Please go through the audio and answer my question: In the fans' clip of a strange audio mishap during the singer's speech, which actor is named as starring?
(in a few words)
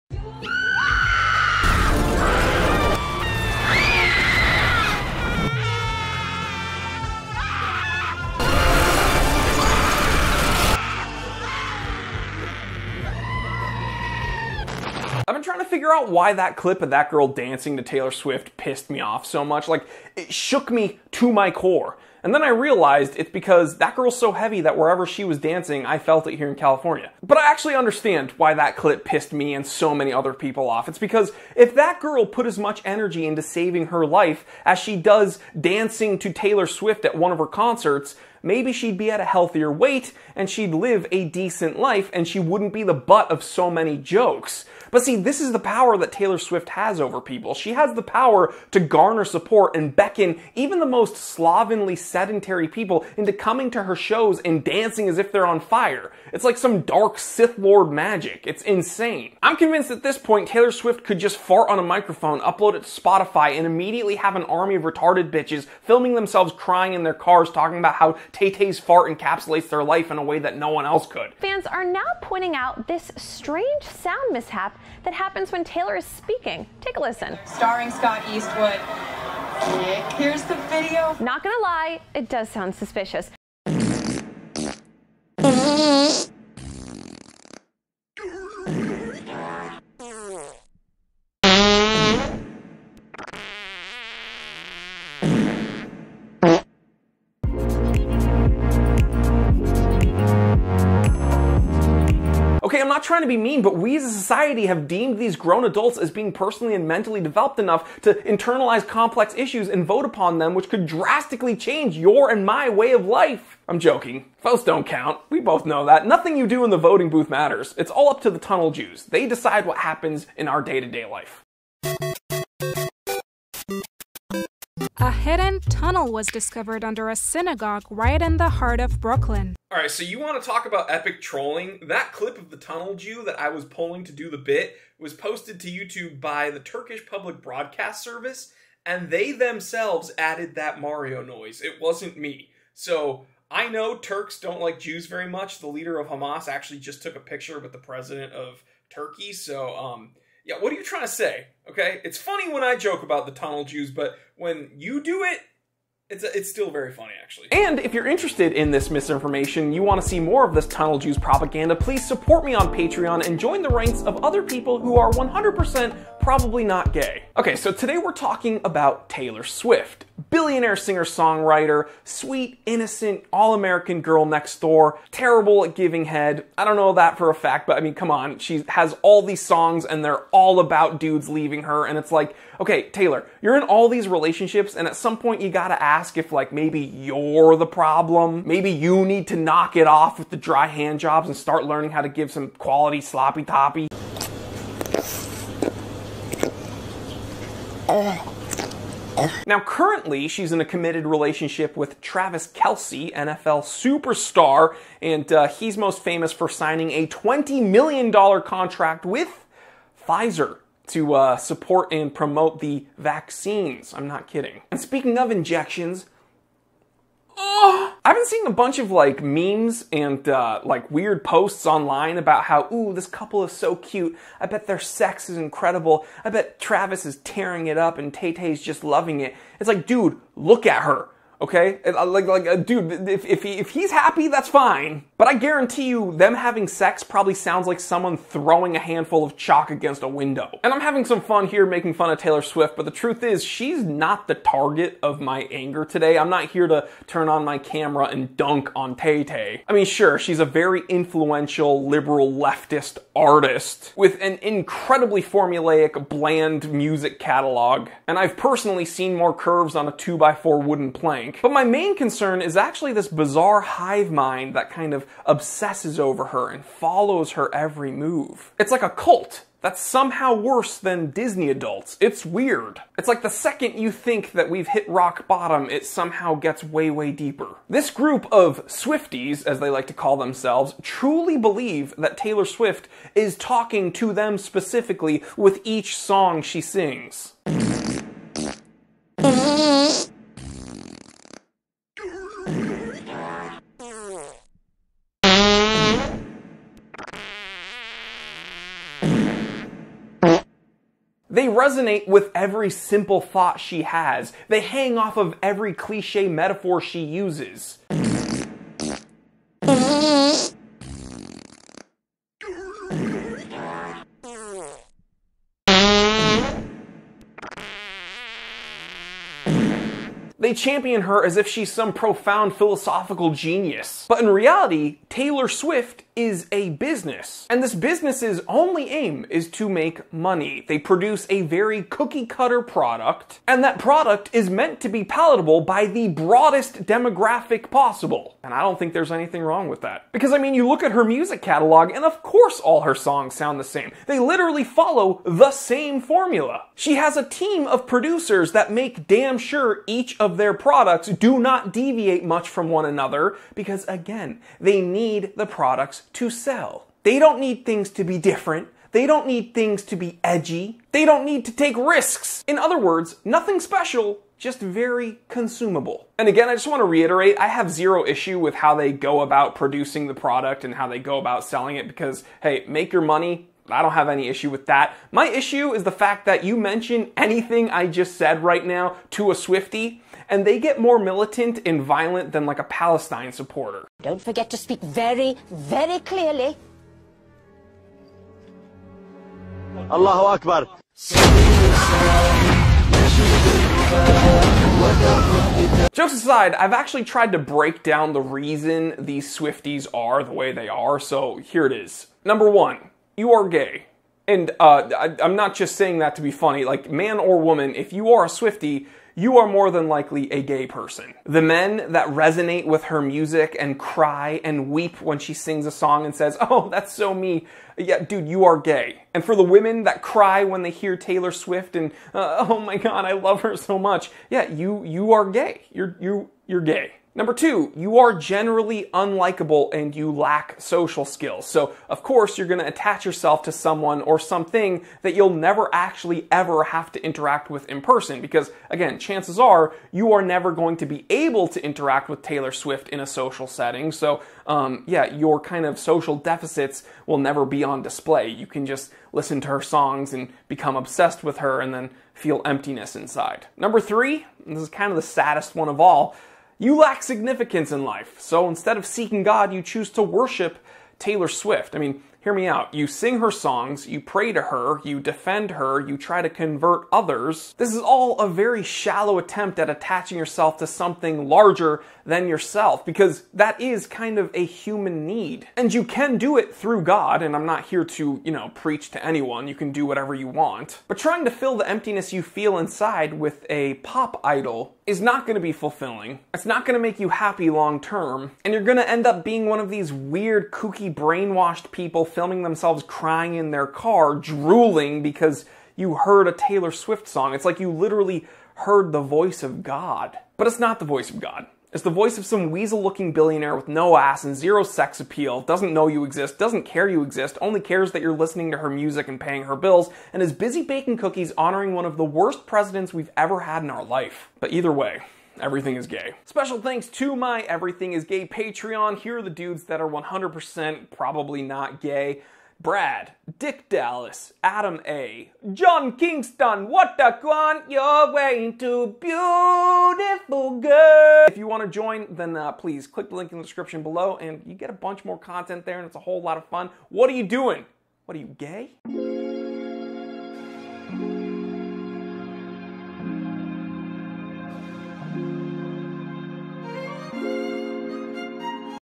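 Scott Eastwood.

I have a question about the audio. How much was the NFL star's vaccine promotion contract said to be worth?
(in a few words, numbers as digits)
$20 million.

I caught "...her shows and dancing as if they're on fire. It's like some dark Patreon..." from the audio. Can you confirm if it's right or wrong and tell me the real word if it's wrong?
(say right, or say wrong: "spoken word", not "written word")
wrong: "Sith", not "Patreon".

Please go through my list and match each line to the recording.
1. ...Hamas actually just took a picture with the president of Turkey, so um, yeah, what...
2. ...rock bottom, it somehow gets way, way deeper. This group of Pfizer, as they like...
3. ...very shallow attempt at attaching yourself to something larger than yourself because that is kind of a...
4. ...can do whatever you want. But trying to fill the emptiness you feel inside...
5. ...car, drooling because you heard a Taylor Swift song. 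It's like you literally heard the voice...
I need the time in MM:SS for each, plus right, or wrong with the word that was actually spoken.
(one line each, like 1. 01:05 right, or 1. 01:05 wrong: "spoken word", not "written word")
1. 02:26 right
2. 04:34 wrong: "Swifties", not "Pfizer"
3. 07:48 right
4. 07:59 right
5. 08:13 right.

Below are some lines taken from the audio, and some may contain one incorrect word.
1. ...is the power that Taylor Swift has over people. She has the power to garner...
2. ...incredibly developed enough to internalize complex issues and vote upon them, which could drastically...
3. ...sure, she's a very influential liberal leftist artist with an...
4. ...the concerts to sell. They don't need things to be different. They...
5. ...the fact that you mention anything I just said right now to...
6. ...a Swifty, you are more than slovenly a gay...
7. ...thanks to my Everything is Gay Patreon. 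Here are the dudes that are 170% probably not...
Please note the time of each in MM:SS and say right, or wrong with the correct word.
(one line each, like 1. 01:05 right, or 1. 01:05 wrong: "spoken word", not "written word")
1. 00:45 right
2. 01:46 wrong: "mentally", not "incredibly"
3. 04:09 right
4. 05:55 wrong: "products", not "concerts"
5. 06:15 right
6. 06:48 wrong: "likely", not "slovenly"
7. 08:36 wrong: "100", not "170".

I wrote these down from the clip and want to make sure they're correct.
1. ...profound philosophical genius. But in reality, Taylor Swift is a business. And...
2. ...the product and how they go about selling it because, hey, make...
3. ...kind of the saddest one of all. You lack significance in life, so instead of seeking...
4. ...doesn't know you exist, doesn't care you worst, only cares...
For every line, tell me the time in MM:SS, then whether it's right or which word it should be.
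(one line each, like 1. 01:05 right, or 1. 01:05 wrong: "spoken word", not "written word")
1. 05:21 right
2. 06:10 right
3. 07:34 right
4. 08:25 wrong: "exist", not "worst".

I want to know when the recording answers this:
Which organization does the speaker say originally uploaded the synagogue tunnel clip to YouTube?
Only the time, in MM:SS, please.
02:16.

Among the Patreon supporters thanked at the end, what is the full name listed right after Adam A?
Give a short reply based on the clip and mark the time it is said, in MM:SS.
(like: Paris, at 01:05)
John Kingston, at 08:45.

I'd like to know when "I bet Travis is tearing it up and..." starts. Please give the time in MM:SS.
03:46.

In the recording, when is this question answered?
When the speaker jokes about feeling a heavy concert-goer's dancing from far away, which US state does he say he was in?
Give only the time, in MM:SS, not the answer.
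00:26.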